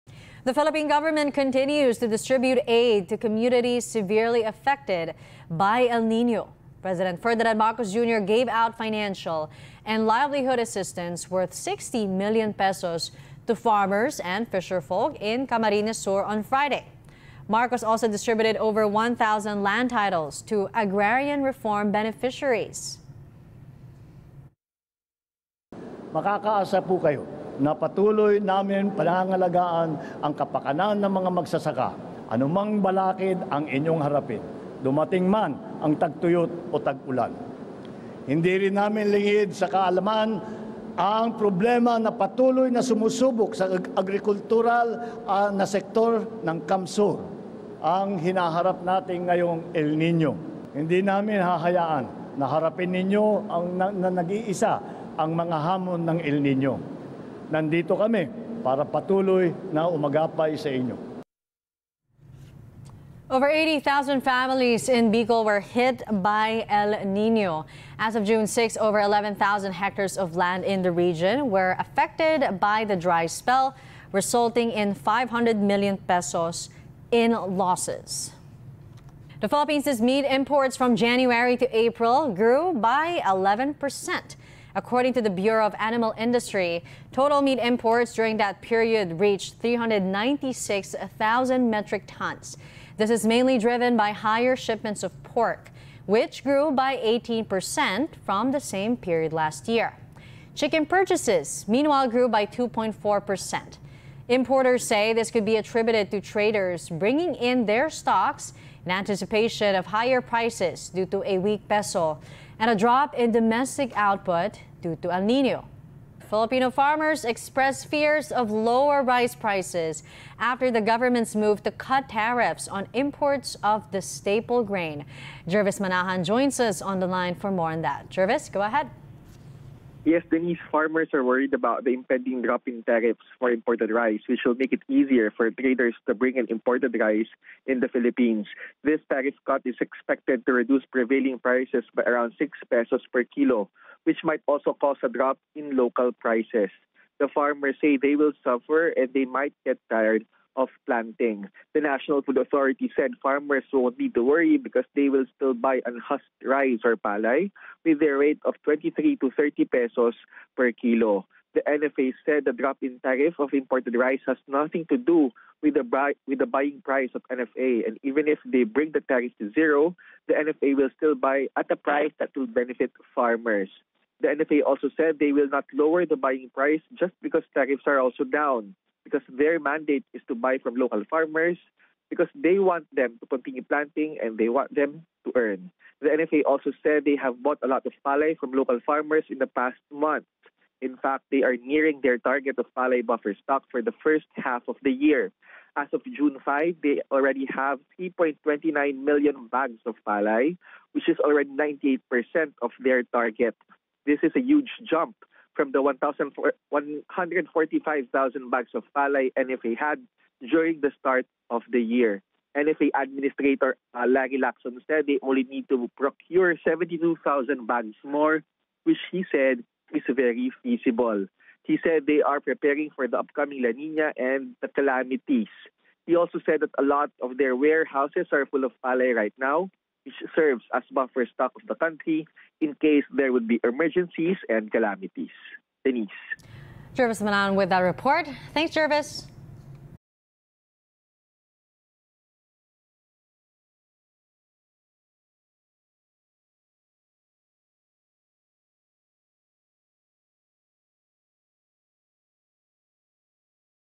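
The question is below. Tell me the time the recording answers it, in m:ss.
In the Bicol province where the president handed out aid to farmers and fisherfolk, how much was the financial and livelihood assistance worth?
0:11.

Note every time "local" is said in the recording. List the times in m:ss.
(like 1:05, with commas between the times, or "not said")
2:25, 3:00, 3:08.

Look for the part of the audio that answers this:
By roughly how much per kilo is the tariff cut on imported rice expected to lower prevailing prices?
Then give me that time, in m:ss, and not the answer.
2:22.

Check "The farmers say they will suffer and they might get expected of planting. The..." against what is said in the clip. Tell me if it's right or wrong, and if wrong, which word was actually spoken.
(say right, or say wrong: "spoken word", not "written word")
wrong: "tired", not "expected".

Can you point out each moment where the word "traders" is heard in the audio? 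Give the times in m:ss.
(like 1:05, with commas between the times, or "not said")
1:46, 2:15.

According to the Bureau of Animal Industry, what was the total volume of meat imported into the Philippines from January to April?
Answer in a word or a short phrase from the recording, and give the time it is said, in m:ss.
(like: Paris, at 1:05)
396,000 metric tons, at 1:29.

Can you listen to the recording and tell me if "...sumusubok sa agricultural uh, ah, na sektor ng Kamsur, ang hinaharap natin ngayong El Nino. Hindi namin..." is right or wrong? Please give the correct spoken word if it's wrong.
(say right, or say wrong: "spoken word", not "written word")
right.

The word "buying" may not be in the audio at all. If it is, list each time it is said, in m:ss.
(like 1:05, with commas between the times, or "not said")
2:46, 2:56.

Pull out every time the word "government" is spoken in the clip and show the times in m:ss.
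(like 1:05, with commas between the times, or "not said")
0:00, 2:00.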